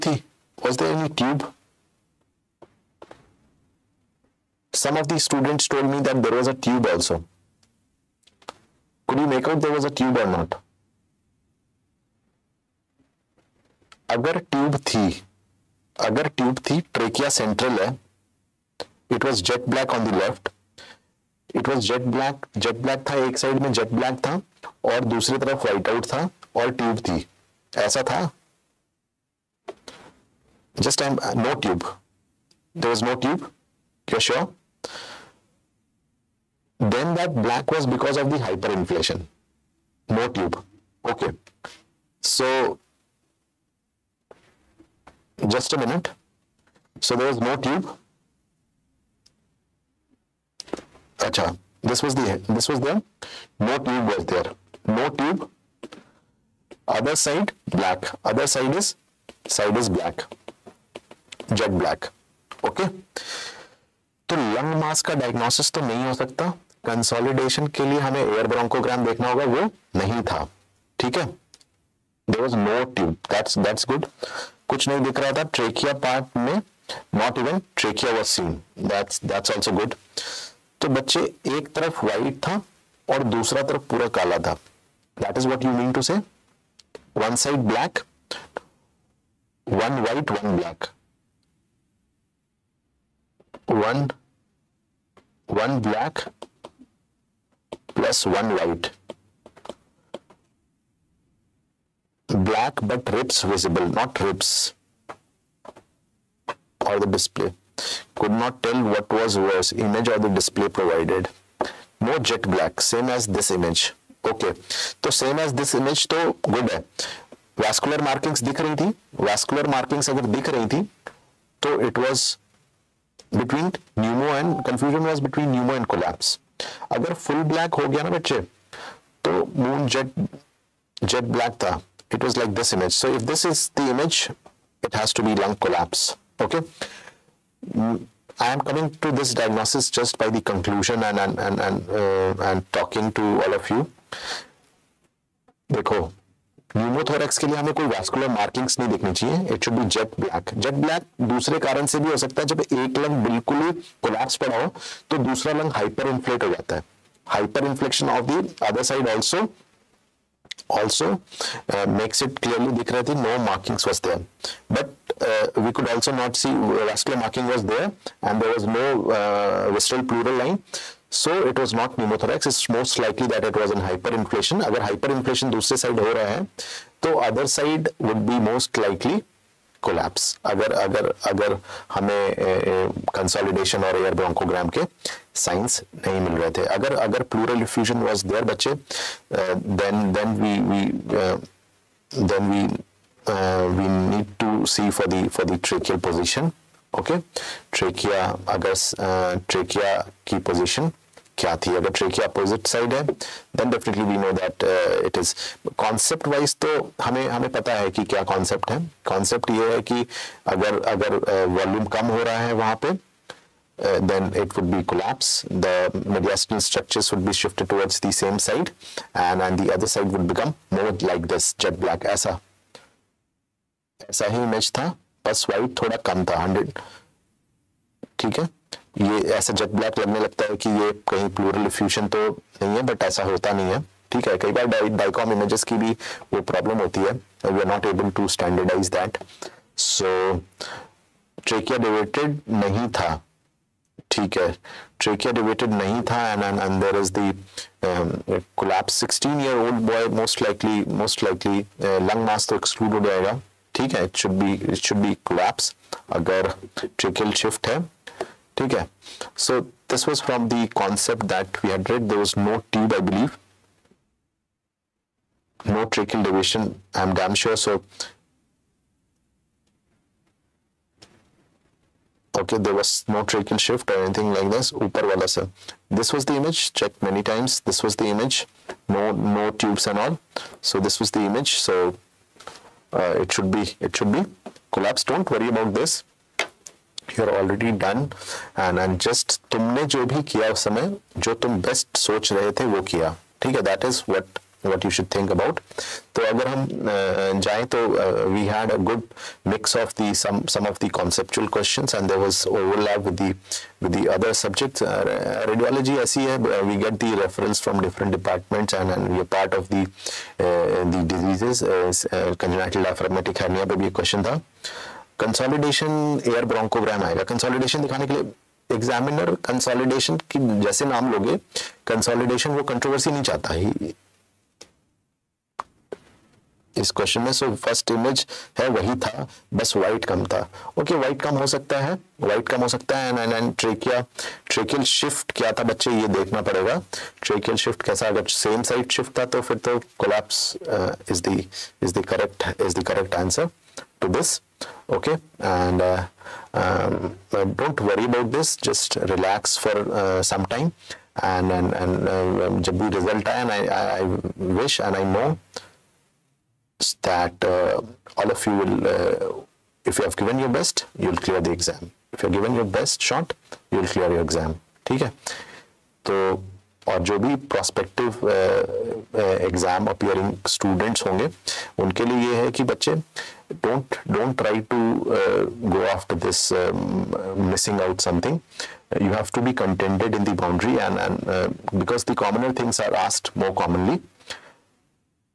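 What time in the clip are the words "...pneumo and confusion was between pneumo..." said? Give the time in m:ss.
2:03.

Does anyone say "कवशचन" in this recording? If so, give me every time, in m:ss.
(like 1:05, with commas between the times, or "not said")
5:01, 5:13, 5:26.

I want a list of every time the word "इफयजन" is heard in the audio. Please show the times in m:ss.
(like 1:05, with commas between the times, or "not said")
3:07.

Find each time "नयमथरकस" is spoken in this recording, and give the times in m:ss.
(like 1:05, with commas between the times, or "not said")
2:26, 2:51.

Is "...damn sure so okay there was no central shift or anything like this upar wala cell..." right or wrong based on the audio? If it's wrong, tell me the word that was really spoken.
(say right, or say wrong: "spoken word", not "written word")
wrong: "tracheal", not "central".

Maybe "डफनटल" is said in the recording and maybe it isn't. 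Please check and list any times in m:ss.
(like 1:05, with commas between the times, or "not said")
3:23.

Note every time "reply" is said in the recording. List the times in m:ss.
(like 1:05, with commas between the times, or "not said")
not said.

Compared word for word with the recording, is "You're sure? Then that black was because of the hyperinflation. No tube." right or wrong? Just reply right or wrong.
right.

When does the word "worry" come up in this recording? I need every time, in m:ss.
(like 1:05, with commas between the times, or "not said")
4:45, 5:47.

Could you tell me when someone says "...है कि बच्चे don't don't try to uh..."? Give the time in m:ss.
6:12.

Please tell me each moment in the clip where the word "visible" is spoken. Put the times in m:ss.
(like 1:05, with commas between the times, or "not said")
1:43.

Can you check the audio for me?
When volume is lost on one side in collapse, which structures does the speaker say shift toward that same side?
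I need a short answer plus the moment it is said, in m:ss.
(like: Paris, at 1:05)
Mediastinal structures, at 3:35.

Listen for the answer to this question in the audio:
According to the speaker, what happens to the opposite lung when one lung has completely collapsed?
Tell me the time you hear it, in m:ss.
2:35.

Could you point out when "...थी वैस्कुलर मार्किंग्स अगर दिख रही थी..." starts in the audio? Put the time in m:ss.
1:58.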